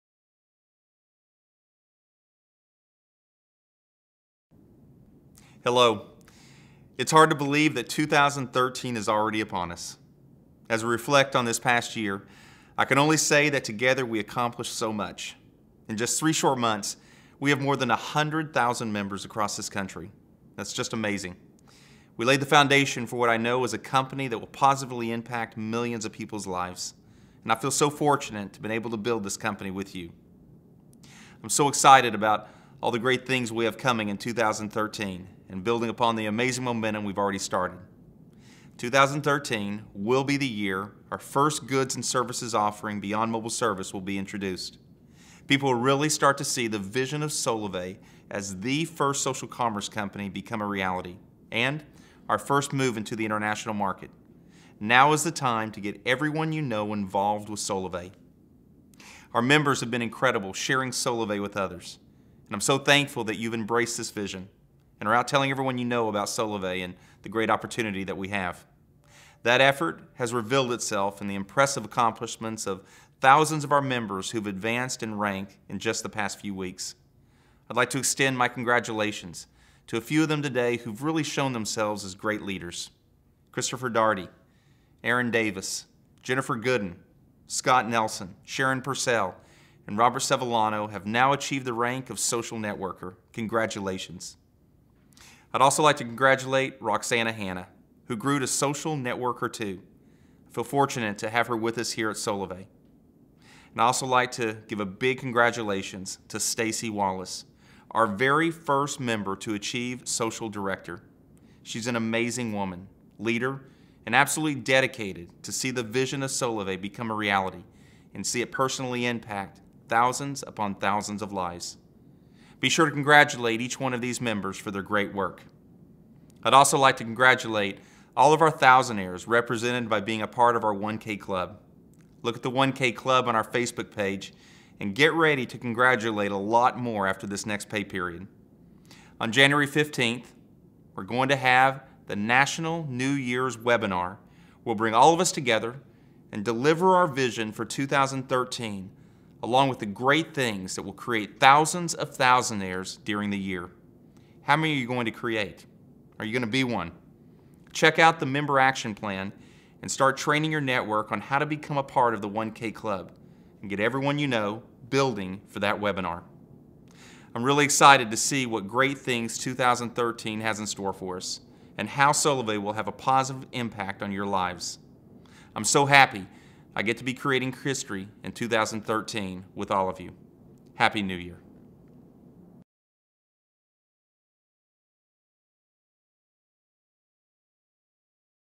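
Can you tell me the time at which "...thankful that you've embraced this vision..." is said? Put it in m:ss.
1:02.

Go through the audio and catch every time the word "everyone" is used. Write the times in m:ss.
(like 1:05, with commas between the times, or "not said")
0:56, 1:05, 2:43.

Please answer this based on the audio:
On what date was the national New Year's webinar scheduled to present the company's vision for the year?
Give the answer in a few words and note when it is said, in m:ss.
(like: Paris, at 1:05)
January 15th, at 2:19.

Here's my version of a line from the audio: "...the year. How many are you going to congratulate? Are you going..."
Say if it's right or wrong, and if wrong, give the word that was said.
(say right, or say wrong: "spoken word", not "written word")
wrong: "create", not "congratulate".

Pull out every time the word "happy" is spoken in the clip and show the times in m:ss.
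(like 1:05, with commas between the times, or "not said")
2:55, 3:00.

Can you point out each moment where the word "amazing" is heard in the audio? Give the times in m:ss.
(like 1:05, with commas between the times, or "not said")
0:20, 0:36, 1:51.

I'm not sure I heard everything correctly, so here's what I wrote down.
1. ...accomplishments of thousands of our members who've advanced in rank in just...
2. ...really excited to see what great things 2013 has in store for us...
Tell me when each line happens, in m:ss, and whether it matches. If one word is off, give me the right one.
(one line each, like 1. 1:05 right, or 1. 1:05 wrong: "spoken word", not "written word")
1. 1:11 right
2. 2:47 right.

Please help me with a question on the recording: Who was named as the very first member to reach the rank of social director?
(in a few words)
Stacy Wallace.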